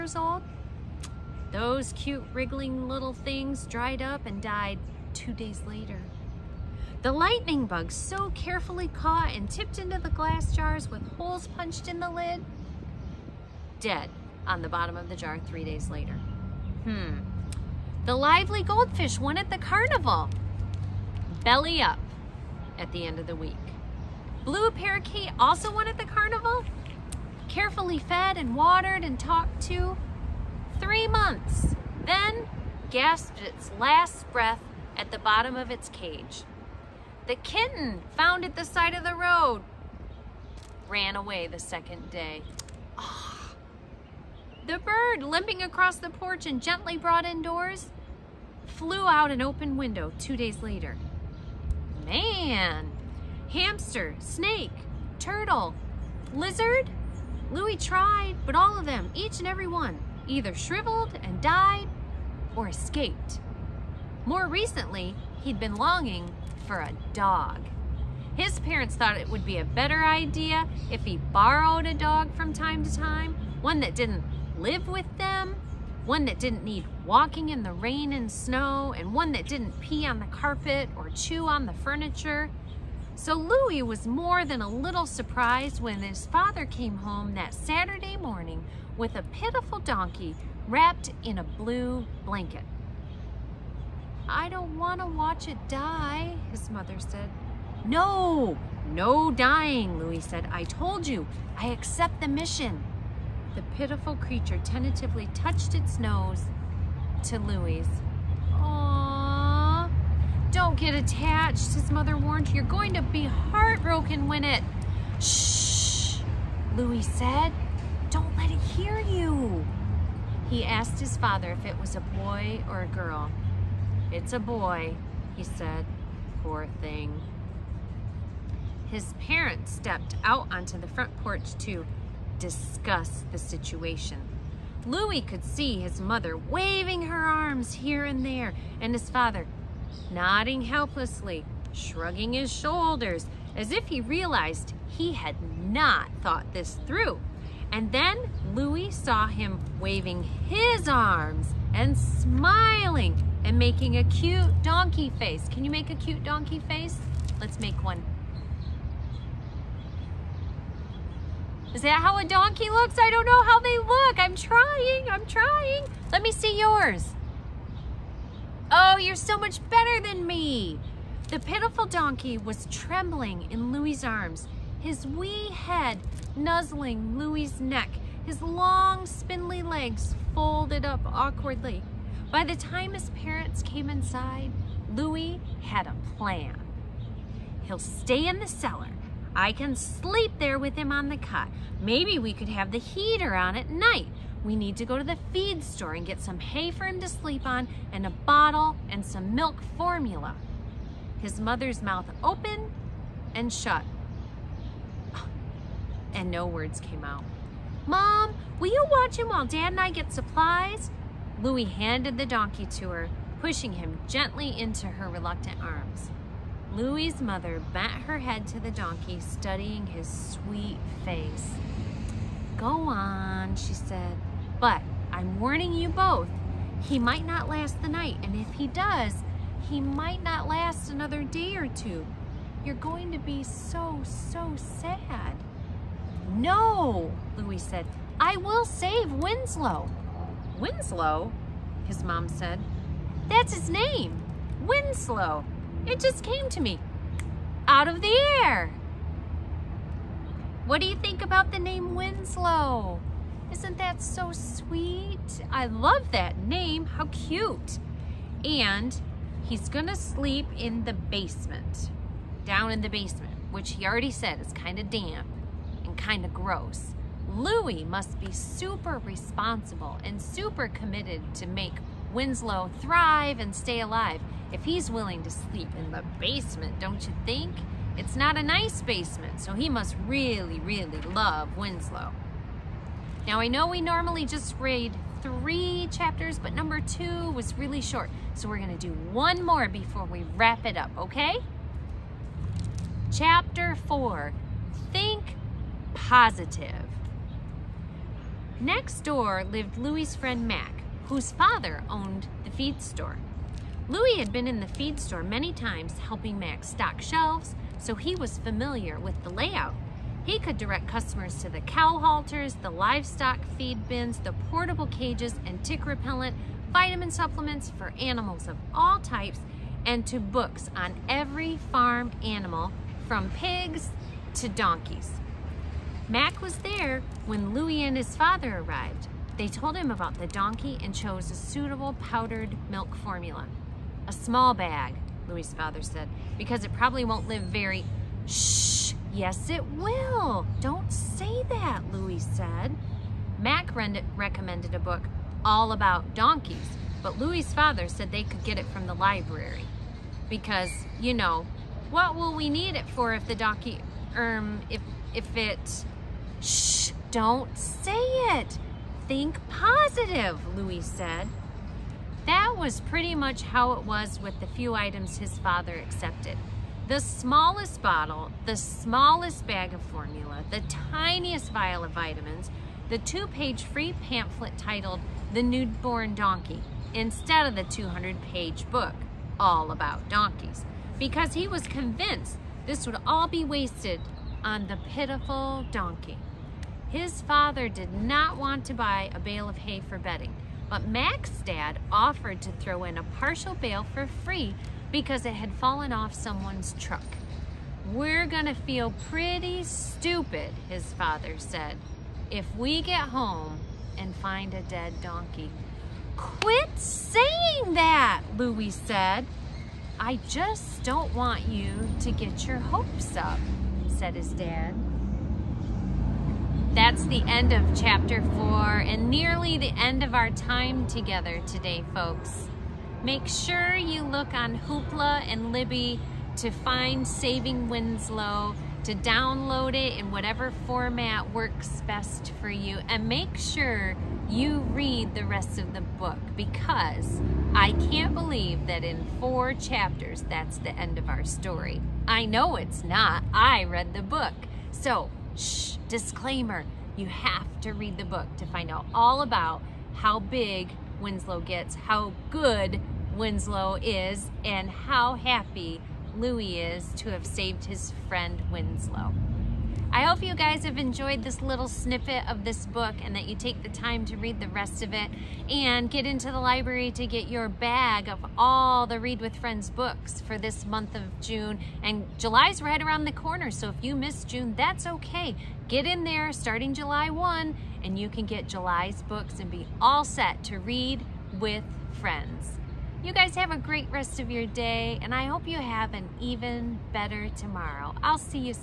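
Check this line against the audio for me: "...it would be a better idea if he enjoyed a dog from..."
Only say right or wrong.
wrong.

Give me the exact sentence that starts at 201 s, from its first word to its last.
His mother's mouth opened and shut.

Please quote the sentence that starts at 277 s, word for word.
It's not a nice basement, so he must really, really love Winslow.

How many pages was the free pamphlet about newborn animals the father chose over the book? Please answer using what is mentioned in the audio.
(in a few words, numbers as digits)
2.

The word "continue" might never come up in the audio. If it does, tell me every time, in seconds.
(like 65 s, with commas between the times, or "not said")
not said.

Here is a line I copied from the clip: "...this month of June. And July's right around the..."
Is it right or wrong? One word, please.
right.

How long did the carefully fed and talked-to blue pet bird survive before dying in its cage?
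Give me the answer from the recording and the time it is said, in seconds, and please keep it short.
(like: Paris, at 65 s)
Three months, at 30 s.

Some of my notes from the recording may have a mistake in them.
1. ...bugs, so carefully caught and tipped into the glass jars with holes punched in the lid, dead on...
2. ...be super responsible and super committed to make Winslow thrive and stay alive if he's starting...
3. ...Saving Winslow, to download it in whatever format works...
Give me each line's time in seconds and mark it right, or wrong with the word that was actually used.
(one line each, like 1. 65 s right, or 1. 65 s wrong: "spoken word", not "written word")
1. 7 s right
2. 268 s wrong: "willing", not "starting"
3. 427 s right.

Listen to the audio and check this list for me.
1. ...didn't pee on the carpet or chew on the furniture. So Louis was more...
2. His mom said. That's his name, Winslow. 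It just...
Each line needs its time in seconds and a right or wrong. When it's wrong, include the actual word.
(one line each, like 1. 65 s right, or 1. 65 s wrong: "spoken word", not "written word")
1. 79 s right
2. 241 s right.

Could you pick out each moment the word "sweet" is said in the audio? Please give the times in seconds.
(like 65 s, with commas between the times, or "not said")
220 s, 254 s.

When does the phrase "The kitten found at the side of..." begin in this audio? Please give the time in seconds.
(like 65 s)
37 s.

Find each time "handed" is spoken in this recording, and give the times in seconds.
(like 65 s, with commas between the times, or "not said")
211 s.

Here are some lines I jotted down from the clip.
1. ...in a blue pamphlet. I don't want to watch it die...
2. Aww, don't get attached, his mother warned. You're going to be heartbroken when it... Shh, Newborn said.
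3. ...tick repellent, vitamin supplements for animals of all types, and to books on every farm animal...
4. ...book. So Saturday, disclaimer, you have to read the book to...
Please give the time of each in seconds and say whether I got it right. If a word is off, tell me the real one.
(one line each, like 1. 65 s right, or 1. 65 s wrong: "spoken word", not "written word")
1. 91 s wrong: "blanket", not "pamphlet"
2. 108 s wrong: "Louis", not "Newborn"
3. 315 s right
4. 444 s wrong: "Shh", not "Saturday".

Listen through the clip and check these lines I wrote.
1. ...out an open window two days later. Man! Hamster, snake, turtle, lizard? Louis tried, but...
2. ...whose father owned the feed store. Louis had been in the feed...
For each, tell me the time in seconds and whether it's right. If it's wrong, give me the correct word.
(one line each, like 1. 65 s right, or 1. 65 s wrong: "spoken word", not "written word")
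1. 49 s right
2. 301 s right.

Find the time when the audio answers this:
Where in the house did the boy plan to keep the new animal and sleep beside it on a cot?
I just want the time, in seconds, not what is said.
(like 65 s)
188 s.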